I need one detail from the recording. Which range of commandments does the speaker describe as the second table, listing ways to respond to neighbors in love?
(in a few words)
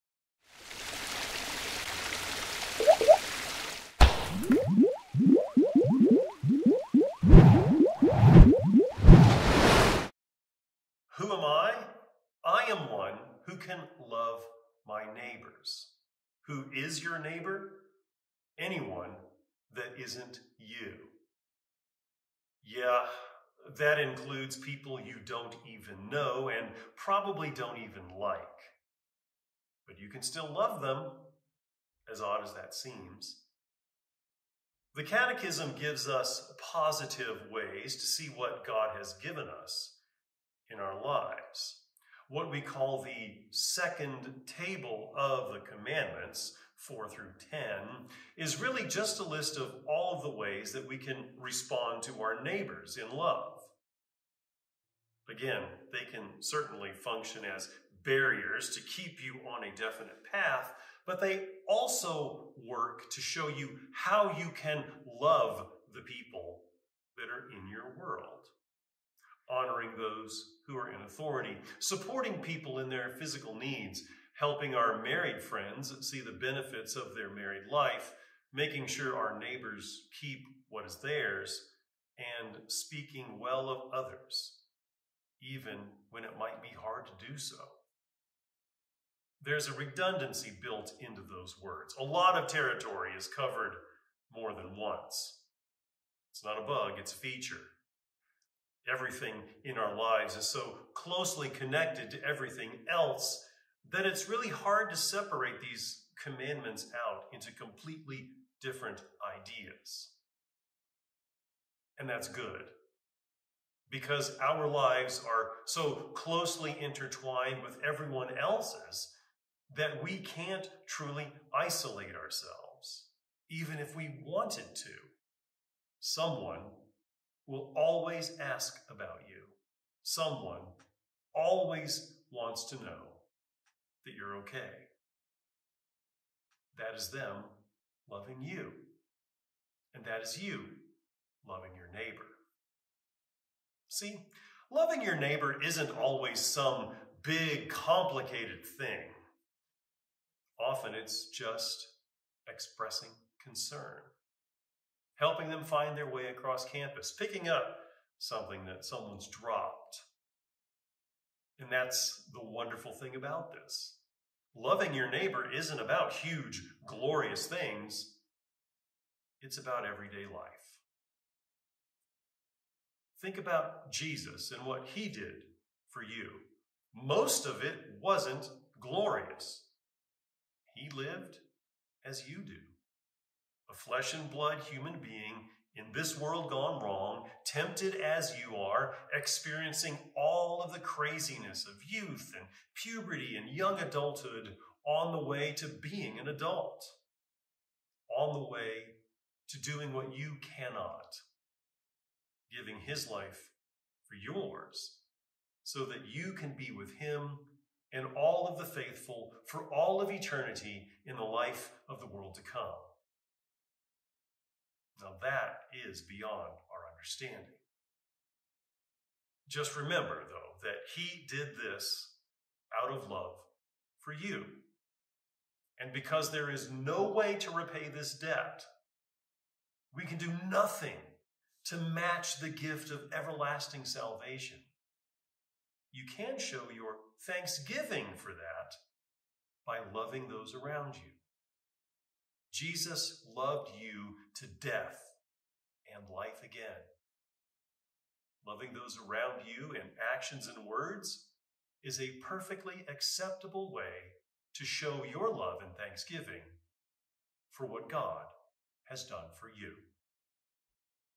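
4 through 10.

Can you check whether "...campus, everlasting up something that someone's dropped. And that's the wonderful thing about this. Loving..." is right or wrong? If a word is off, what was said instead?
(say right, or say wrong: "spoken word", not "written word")
wrong: "picking", not "everlasting".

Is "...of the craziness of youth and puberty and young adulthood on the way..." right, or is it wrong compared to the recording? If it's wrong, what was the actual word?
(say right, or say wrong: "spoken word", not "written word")
right.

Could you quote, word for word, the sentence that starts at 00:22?
Yeah, that includes people you don't even know and probably don't even like.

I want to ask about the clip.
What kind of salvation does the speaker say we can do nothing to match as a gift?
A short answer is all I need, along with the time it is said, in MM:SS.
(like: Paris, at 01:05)
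Everlasting salvation, at 03:53.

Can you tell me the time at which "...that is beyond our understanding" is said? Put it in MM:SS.
03:35.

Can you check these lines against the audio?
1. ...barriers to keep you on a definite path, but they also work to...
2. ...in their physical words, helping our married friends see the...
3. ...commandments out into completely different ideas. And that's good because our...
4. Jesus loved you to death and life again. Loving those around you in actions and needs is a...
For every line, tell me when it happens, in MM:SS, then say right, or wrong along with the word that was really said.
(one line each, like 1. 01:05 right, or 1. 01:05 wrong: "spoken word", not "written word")
1. 00:58 right
2. 01:12 wrong: "needs", not "words"
3. 01:46 right
4. 04:02 wrong: "words", not "needs".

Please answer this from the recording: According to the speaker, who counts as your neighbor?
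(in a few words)
Anyone that isn't you.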